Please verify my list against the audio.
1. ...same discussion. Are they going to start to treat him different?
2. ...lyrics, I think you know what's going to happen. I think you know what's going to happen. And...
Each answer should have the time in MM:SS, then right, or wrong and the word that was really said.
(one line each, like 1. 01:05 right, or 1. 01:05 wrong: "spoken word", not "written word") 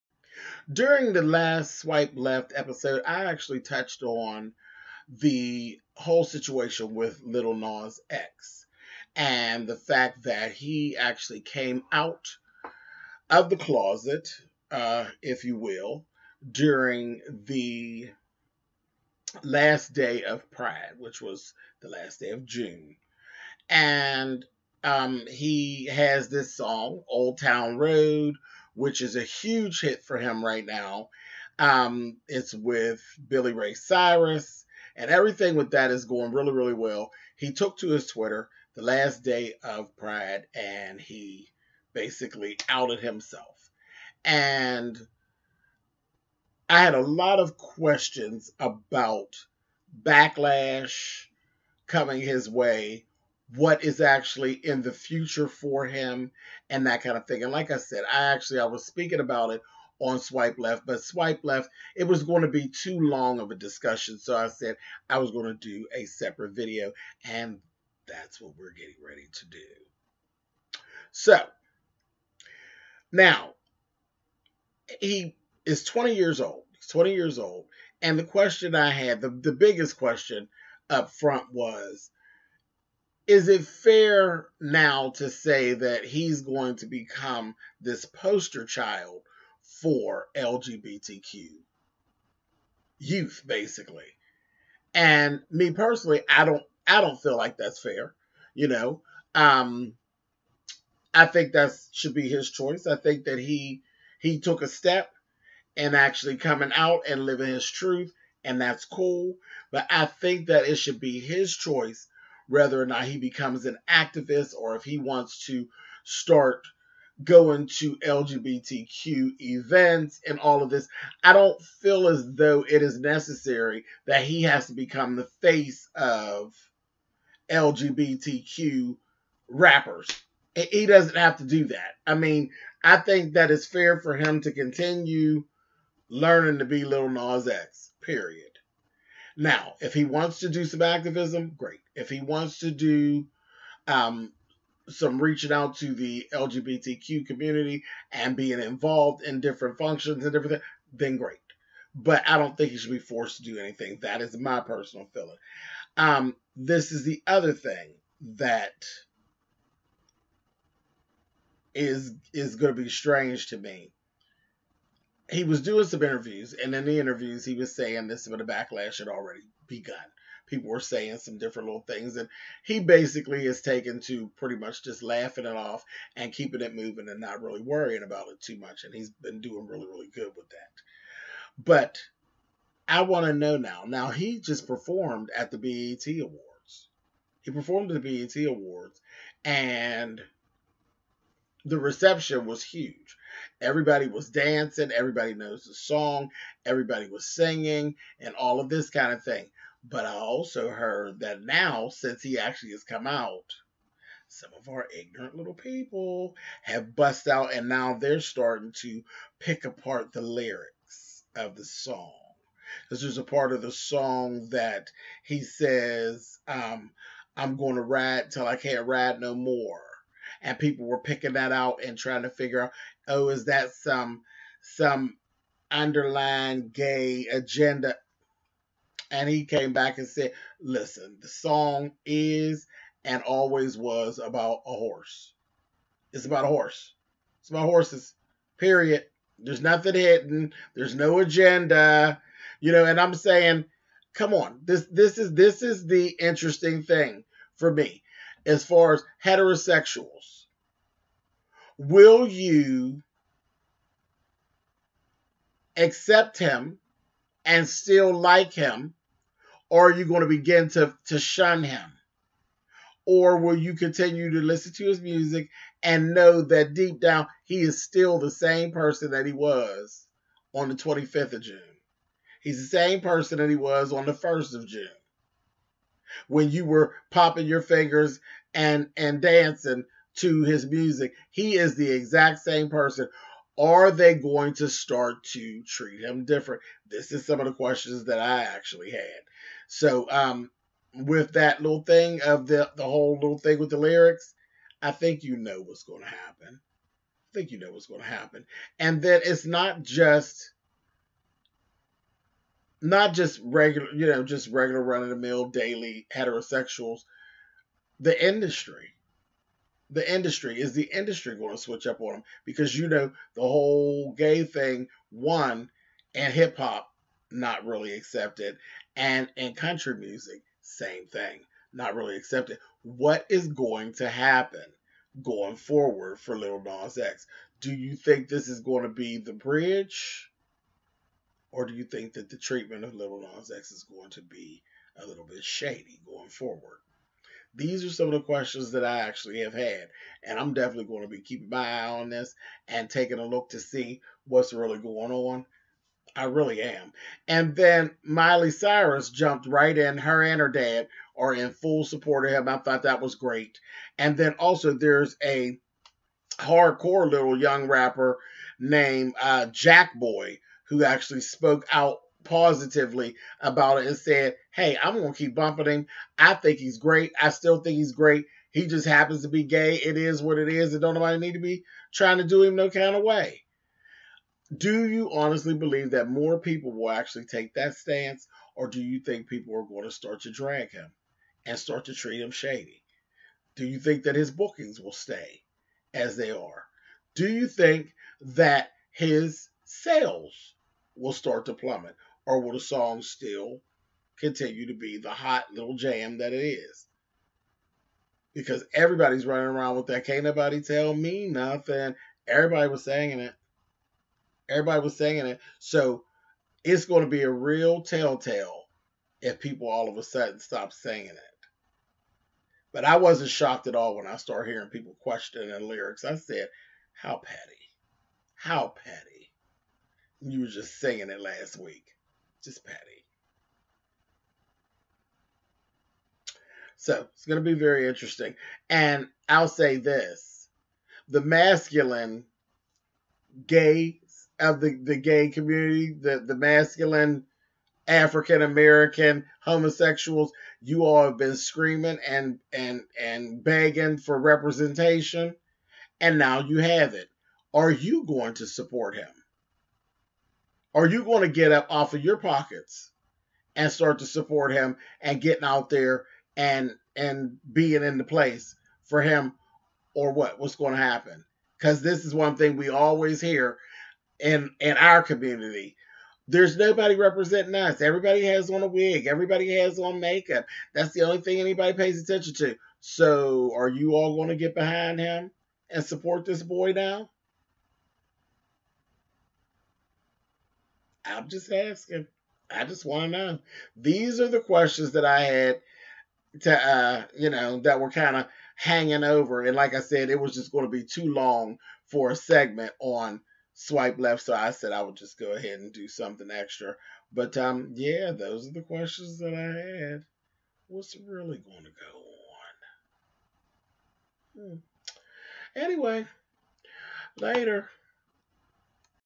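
1. 04:42 wrong: "person", not "discussion"
2. 04:53 right.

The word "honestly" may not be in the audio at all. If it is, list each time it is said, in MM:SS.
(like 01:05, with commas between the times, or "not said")
06:15.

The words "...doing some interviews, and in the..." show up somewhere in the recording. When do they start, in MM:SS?
02:45.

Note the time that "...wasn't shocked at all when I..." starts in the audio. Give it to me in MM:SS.
06:52.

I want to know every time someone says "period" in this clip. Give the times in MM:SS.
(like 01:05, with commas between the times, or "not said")
02:18, 03:58.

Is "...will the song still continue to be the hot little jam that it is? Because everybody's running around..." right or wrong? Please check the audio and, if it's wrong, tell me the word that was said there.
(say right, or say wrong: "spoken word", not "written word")
right.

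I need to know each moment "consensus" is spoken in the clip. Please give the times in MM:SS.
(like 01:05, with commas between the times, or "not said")
not said.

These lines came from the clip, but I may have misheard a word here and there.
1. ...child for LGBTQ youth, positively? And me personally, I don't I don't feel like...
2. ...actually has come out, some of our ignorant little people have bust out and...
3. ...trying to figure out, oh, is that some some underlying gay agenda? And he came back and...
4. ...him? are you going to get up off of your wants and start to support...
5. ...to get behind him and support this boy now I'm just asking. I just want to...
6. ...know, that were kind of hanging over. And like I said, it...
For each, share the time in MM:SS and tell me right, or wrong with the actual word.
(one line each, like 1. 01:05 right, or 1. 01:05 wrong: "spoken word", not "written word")
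1. 01:28 wrong: "basically", not "positively"
2. 03:22 right
3. 03:41 right
4. 07:28 wrong: "pockets", not "wants"
5. 07:54 right
6. 08:07 right.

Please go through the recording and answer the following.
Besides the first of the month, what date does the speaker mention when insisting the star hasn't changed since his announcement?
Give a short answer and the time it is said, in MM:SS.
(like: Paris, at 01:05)
25th of June, at 04:30.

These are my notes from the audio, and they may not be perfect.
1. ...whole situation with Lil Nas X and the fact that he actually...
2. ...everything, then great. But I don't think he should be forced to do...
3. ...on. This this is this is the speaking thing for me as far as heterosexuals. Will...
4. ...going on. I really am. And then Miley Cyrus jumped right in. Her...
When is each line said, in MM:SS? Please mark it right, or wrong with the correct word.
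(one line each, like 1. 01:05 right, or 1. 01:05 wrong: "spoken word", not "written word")
1. 00:05 right
2. 02:30 right
3. 04:04 wrong: "interesting", not "speaking"
4. 05:44 right.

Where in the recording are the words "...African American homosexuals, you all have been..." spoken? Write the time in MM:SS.
07:17.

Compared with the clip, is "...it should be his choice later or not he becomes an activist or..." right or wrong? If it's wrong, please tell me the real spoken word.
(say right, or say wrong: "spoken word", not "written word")
wrong: "whether", not "later".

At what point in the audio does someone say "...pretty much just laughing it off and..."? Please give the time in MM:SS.
02:54.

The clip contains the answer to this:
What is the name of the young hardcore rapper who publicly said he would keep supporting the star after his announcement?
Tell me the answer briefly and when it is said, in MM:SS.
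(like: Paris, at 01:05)
Jackboy, at 05:59.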